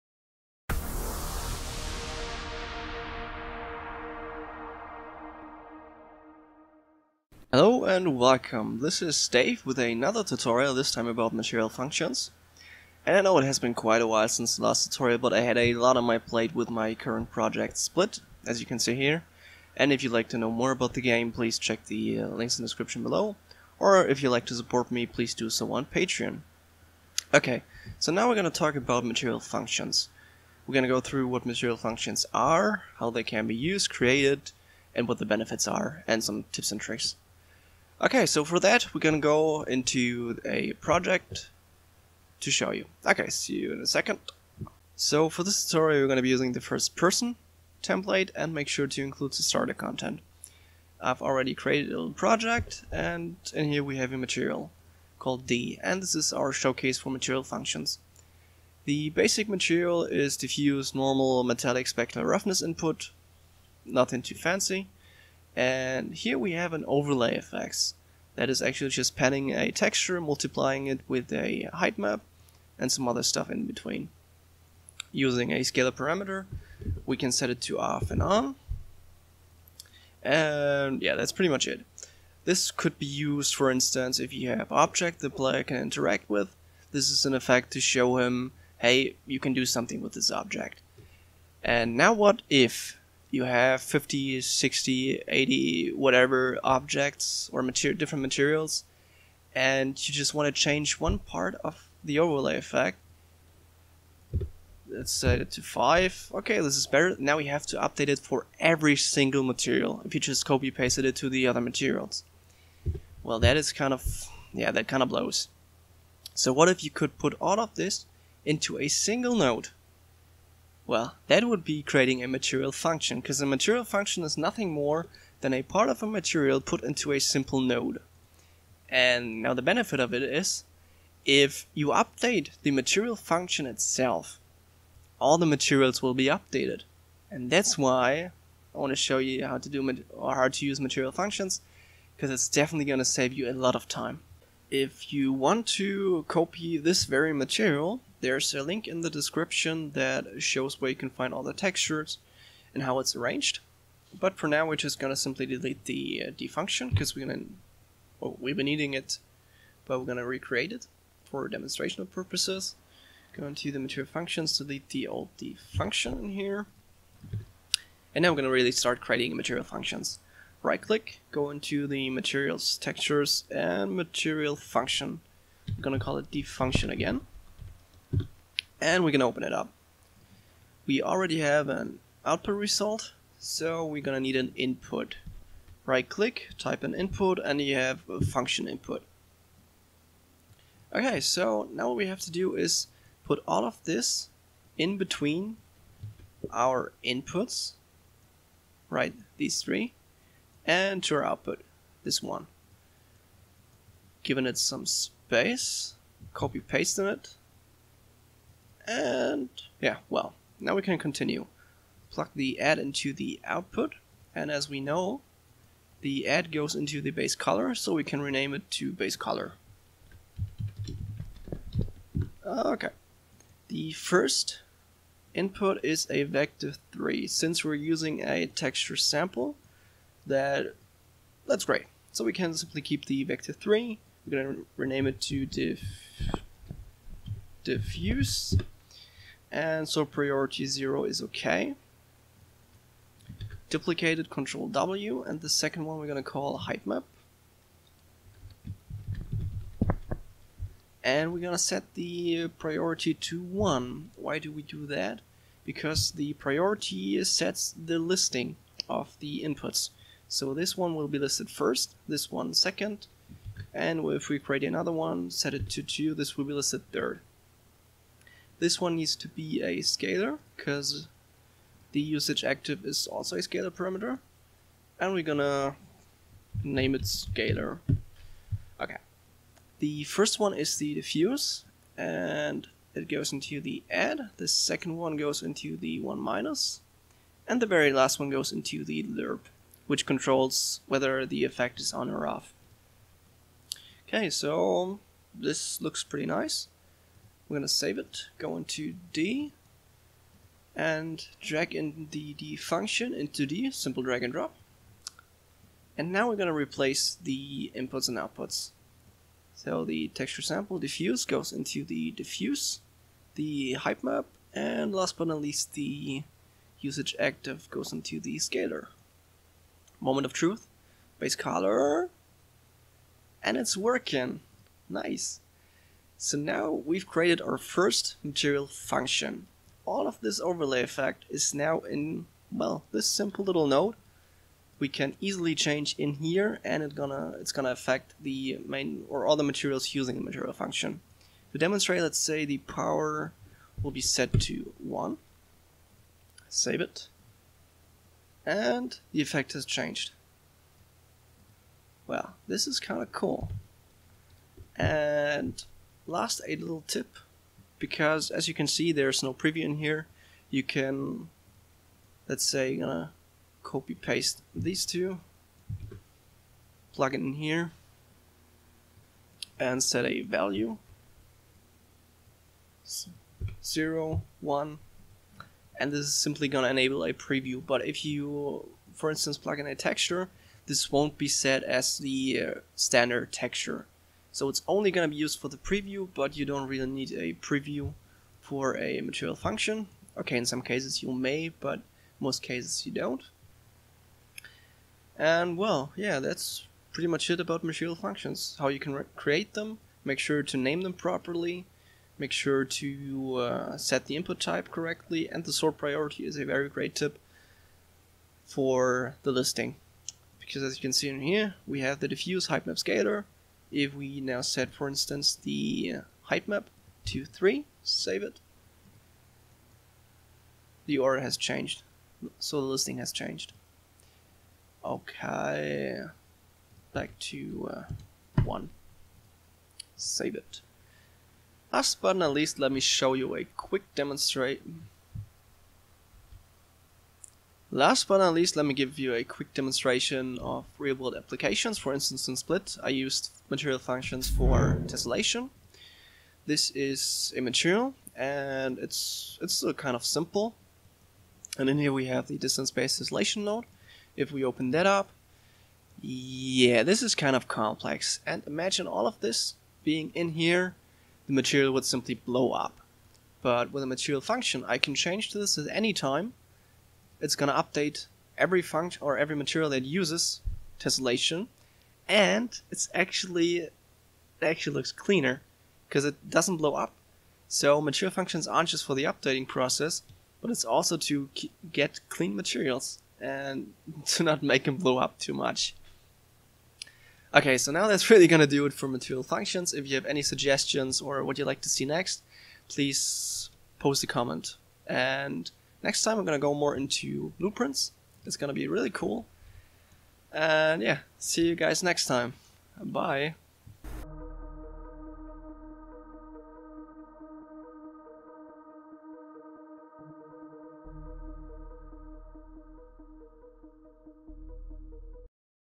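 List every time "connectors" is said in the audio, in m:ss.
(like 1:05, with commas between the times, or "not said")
not said.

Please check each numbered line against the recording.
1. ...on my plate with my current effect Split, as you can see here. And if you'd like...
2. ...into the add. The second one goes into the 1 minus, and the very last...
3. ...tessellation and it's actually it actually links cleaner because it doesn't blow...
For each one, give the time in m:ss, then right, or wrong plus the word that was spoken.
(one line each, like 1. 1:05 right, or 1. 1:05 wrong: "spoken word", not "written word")
1. 0:15 wrong: "project", not "effect"
2. 4:43 right
3. 7:50 wrong: "looks", not "links".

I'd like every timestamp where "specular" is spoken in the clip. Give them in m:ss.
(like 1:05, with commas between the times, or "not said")
1:01.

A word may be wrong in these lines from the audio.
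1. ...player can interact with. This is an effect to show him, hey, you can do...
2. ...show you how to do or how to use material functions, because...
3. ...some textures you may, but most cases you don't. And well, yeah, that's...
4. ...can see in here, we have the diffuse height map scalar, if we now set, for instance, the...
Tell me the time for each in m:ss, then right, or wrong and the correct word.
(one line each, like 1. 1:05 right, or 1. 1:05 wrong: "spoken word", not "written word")
1. 1:25 right
2. 2:18 right
3. 6:30 wrong: "cases", not "textures"
4. 6:50 right.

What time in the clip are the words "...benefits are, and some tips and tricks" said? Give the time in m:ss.
0:35.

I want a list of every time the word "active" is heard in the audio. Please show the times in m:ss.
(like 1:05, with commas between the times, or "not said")
4:32, 5:17.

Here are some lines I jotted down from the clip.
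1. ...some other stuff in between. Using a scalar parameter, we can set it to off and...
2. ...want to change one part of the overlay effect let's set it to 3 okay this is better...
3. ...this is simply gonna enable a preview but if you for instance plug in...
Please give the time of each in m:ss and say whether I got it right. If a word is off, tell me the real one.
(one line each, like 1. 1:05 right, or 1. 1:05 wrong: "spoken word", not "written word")
1. 1:12 right
2. 1:40 wrong: "5", not "3"
3. 6:15 right.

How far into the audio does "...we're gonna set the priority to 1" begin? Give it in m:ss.
4:11.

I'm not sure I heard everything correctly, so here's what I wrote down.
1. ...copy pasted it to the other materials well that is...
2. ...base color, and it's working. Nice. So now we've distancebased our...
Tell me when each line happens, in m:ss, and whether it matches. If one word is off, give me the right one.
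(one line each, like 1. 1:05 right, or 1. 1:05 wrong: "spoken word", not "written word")
1. 1:50 right
2. 5:21 wrong: "created", not "distancebased".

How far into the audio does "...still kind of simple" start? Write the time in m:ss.
7:29.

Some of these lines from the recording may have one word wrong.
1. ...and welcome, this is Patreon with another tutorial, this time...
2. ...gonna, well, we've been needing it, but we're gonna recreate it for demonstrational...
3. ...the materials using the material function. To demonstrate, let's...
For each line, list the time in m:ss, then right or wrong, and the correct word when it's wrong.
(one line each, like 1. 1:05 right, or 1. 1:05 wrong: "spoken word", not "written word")
1. 0:07 wrong: "Dave", not "Patreon"
2. 2:37 right
3. 5:39 right.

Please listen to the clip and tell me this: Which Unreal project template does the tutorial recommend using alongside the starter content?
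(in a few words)
first person template.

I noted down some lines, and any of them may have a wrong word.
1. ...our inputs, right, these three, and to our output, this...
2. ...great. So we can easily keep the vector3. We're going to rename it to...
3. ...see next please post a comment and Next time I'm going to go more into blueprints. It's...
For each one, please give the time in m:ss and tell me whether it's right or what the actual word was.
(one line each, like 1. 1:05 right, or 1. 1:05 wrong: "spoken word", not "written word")
1. 3:16 right
2. 3:51 wrong: "simply", not "easily"
3. 8:11 right.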